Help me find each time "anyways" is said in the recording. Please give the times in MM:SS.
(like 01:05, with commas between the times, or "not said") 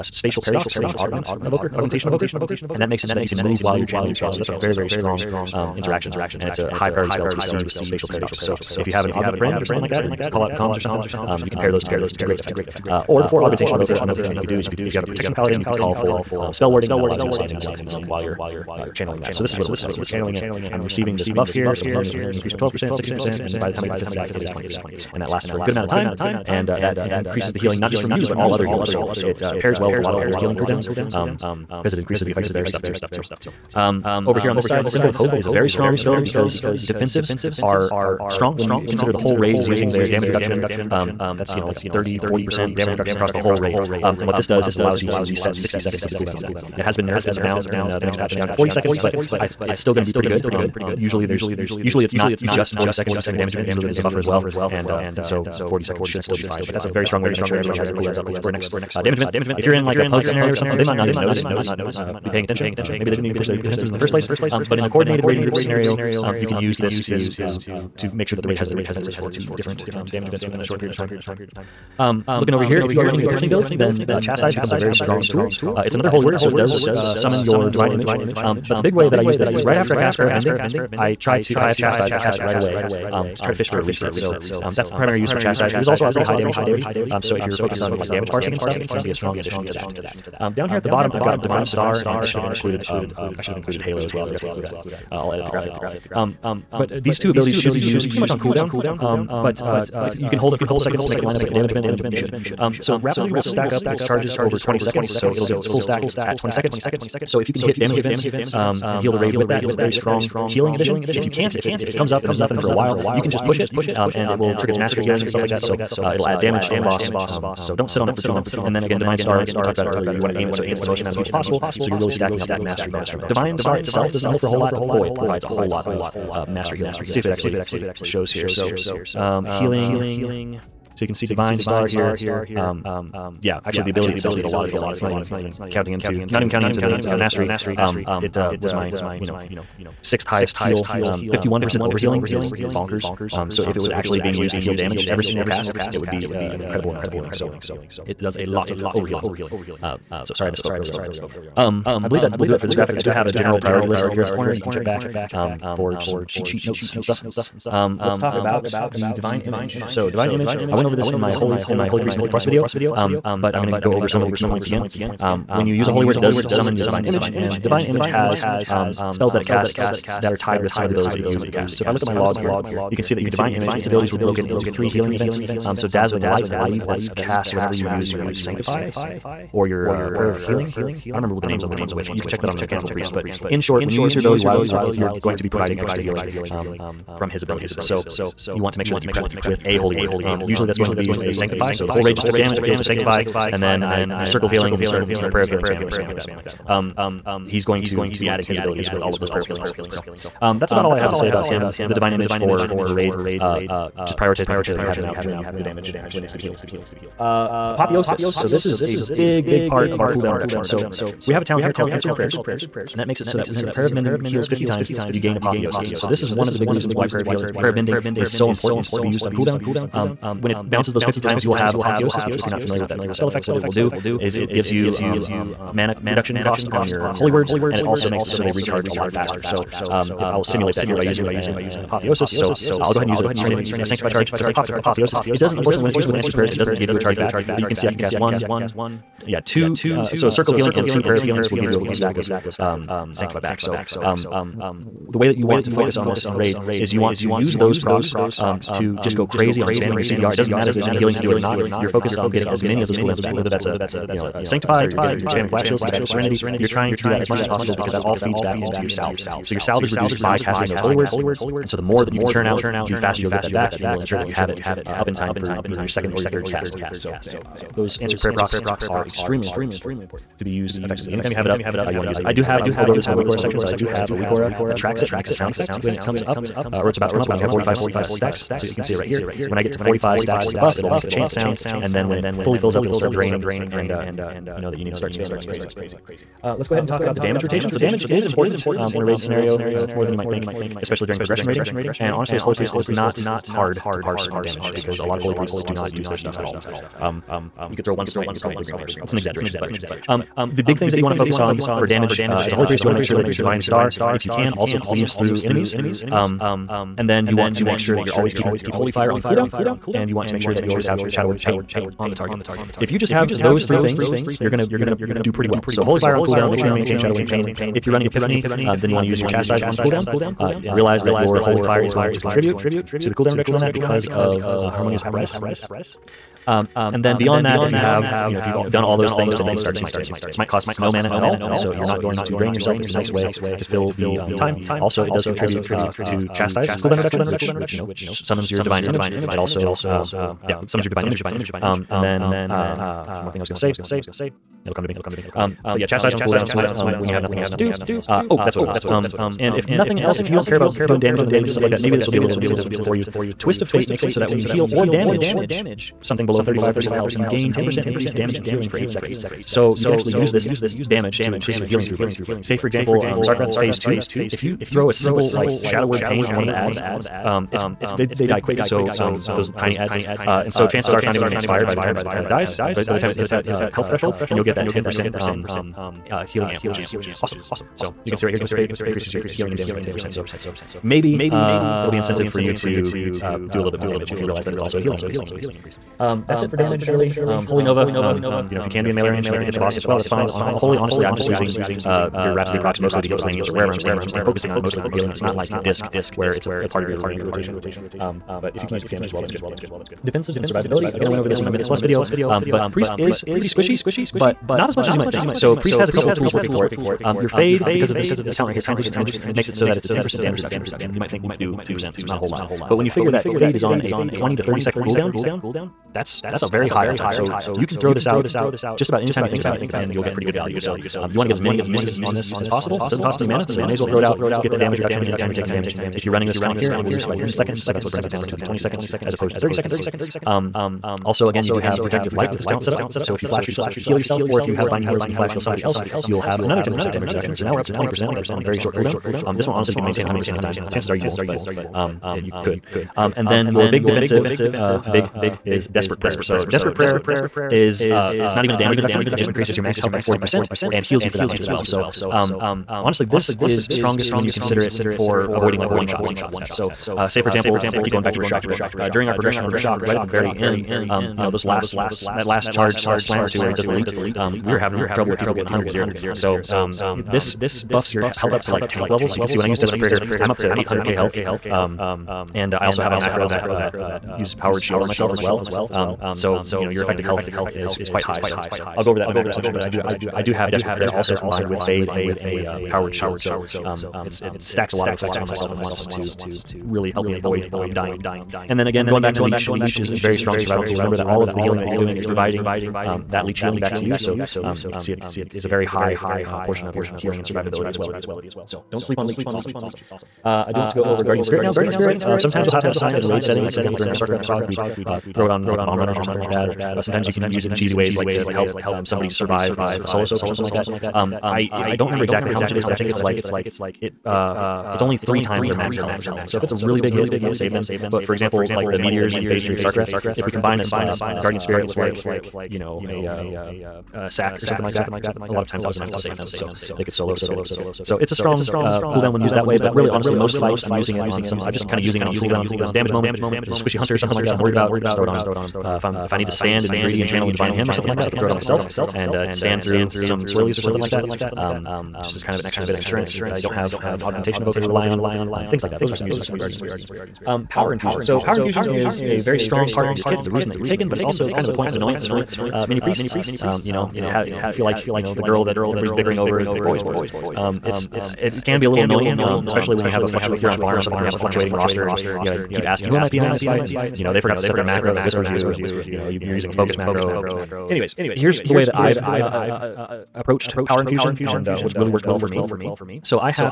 09:27.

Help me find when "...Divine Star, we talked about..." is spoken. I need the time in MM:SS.
01:58.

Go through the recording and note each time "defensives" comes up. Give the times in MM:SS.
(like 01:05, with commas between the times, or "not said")
00:36, 01:03, 01:08, 06:40, 07:23.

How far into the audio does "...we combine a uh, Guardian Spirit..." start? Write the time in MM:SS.
08:40.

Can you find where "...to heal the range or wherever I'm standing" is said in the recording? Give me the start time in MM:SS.
06:33.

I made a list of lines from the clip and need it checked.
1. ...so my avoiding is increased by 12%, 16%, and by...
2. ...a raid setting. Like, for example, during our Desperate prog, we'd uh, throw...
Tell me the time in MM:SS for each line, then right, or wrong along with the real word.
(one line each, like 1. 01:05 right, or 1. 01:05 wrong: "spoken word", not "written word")
1. 00:21 wrong: "healing", not "avoiding"
2. 08:23 wrong: "Sarkareth", not "Desperate".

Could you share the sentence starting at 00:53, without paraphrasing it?
Usually there's a buffer as well, and uh, and so 40 seconds should still be fine.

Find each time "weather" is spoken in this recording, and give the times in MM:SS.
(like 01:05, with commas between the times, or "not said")
not said.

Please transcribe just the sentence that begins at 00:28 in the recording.
So it uh, pairs well with a lot of other healing cooldowns, because um, it increases the effect of their stuff too.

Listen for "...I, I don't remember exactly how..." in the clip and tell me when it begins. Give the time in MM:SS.
08:31.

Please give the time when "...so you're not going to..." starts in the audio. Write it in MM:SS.
05:31.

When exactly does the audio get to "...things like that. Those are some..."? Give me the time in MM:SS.
09:05.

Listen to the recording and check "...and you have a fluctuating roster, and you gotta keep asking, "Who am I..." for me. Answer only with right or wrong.
right.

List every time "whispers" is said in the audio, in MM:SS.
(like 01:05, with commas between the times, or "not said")
09:25.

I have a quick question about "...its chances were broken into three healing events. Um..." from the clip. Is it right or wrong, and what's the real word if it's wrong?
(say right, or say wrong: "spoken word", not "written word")
wrong: "abilities", not "chances".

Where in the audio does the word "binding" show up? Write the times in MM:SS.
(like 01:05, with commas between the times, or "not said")
07:14.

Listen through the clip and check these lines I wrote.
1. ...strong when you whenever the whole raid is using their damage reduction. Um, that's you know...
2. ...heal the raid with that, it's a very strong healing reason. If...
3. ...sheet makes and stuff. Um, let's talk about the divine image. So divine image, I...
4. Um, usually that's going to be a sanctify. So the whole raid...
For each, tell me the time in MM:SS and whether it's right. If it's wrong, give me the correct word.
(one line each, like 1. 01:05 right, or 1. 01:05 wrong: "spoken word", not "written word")
1. 00:38 wrong: "consider", not "whenever"
2. 01:48 wrong: "addition", not "reason"
3. 02:36 wrong: "notes", not "makes"
4. 03:10 right.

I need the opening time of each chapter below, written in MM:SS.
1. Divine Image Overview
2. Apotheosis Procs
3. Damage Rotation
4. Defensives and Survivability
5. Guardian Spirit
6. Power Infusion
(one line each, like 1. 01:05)
1. 02:37
2. 03:26
3. 04:46
4. 06:39
5. 08:19
6. 09:06.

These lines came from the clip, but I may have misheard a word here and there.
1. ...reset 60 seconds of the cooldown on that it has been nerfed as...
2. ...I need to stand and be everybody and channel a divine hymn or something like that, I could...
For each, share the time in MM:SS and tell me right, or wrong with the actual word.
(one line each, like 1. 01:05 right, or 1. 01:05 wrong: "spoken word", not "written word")
1. 00:45 right
2. 08:56 wrong: "greedy", not "everybody".